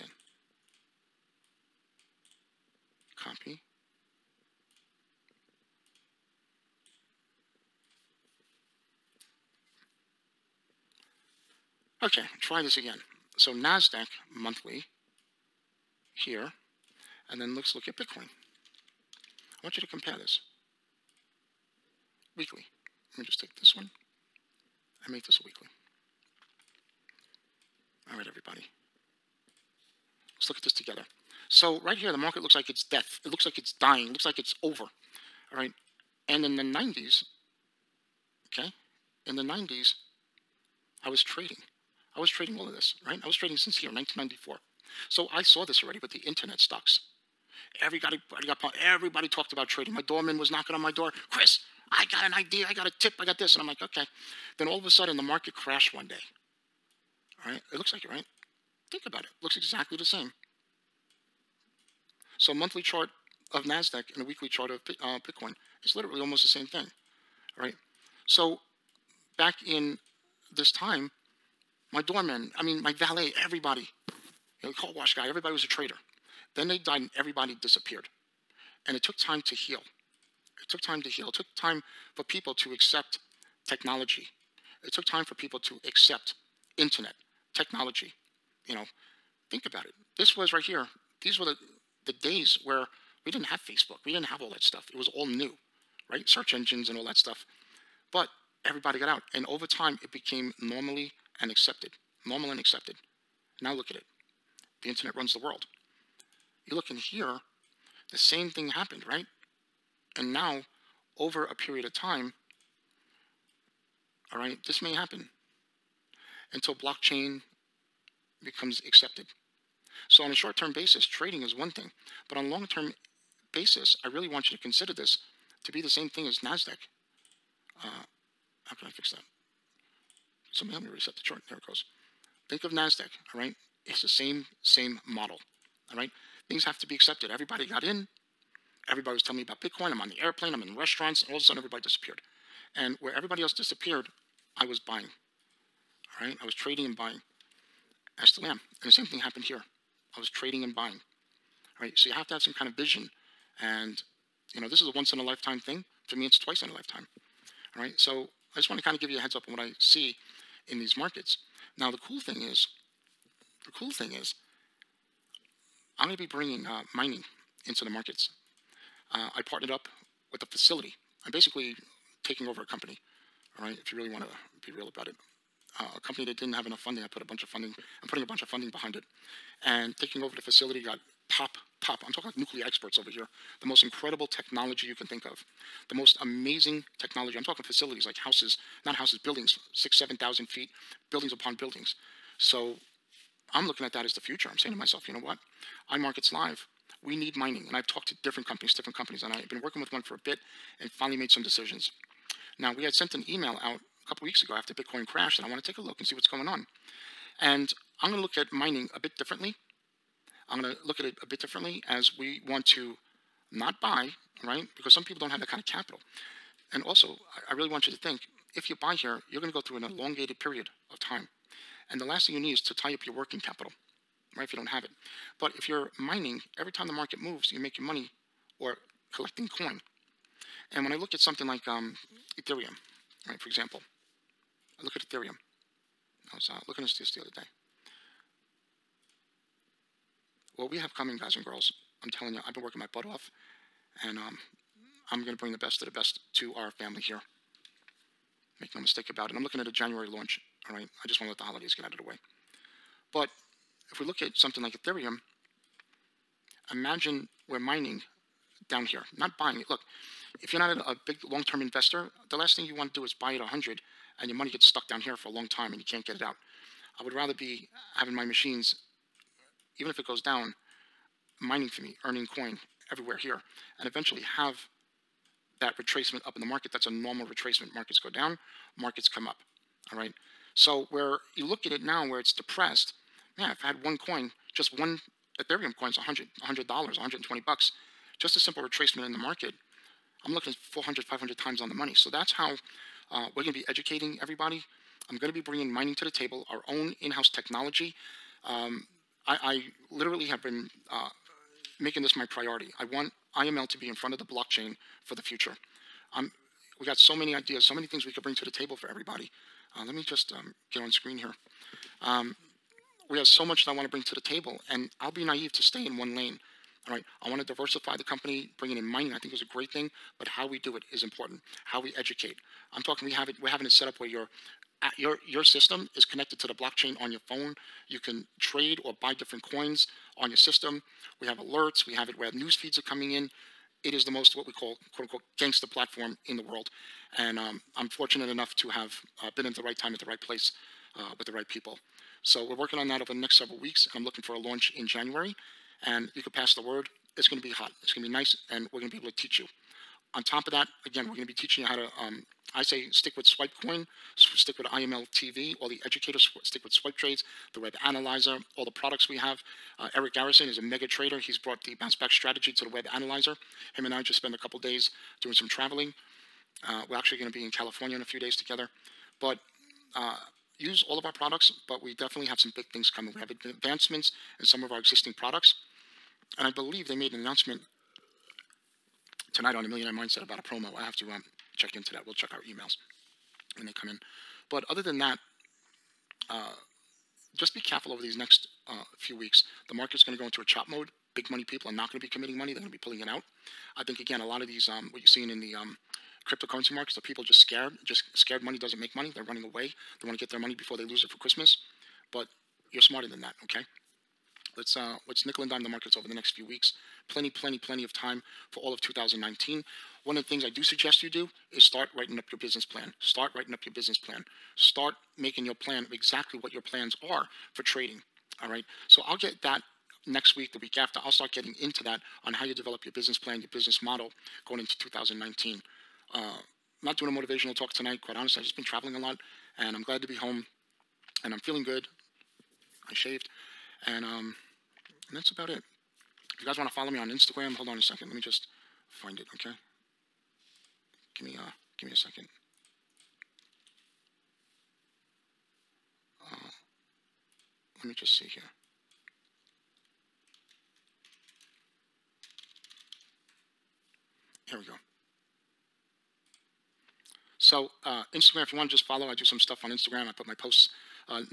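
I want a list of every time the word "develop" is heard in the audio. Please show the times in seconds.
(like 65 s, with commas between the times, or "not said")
422 s.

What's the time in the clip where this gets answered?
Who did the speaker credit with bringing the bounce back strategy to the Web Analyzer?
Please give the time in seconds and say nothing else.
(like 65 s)
359 s.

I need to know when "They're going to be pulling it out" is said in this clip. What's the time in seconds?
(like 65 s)
392 s.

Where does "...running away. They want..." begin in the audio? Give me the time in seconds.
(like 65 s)
399 s.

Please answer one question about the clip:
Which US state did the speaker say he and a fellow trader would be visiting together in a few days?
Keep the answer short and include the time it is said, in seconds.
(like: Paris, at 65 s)
California, at 367 s.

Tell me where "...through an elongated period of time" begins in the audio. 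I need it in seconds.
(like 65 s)
219 s.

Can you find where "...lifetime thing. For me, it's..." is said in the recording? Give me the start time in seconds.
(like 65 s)
155 s.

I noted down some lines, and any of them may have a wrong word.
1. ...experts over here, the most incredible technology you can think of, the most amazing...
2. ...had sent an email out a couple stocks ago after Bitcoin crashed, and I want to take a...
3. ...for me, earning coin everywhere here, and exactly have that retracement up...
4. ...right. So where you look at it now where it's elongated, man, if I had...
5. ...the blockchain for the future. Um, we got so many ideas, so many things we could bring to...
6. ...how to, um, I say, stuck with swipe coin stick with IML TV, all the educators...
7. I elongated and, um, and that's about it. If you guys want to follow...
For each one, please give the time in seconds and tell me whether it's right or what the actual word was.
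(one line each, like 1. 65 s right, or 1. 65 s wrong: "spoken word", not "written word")
1. 182 s right
2. 202 s wrong: "weeks", not "stocks"
3. 271 s wrong: "eventually", not "exactly"
4. 279 s wrong: "depressed", not "elongated"
5. 304 s right
6. 351 s wrong: "stick", not "stuck"
7. 432 s wrong: "shaved", not "elongated".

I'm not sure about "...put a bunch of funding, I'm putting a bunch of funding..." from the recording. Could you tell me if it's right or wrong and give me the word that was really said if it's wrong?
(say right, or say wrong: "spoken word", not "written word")
right.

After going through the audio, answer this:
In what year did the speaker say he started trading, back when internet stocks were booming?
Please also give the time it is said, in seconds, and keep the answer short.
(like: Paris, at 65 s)
1994, at 43 s.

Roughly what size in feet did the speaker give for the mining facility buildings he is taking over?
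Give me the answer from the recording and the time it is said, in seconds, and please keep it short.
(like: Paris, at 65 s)
6,000 to 7,000 feet, at 189 s.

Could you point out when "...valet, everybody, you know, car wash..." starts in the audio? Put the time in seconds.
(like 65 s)
72 s.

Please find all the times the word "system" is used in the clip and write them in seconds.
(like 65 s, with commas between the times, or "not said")
325 s, 330 s.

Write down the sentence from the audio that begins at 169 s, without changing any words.
Uh, I partnered up with the facility.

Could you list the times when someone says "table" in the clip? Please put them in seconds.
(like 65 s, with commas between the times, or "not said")
296 s, 308 s, 314 s.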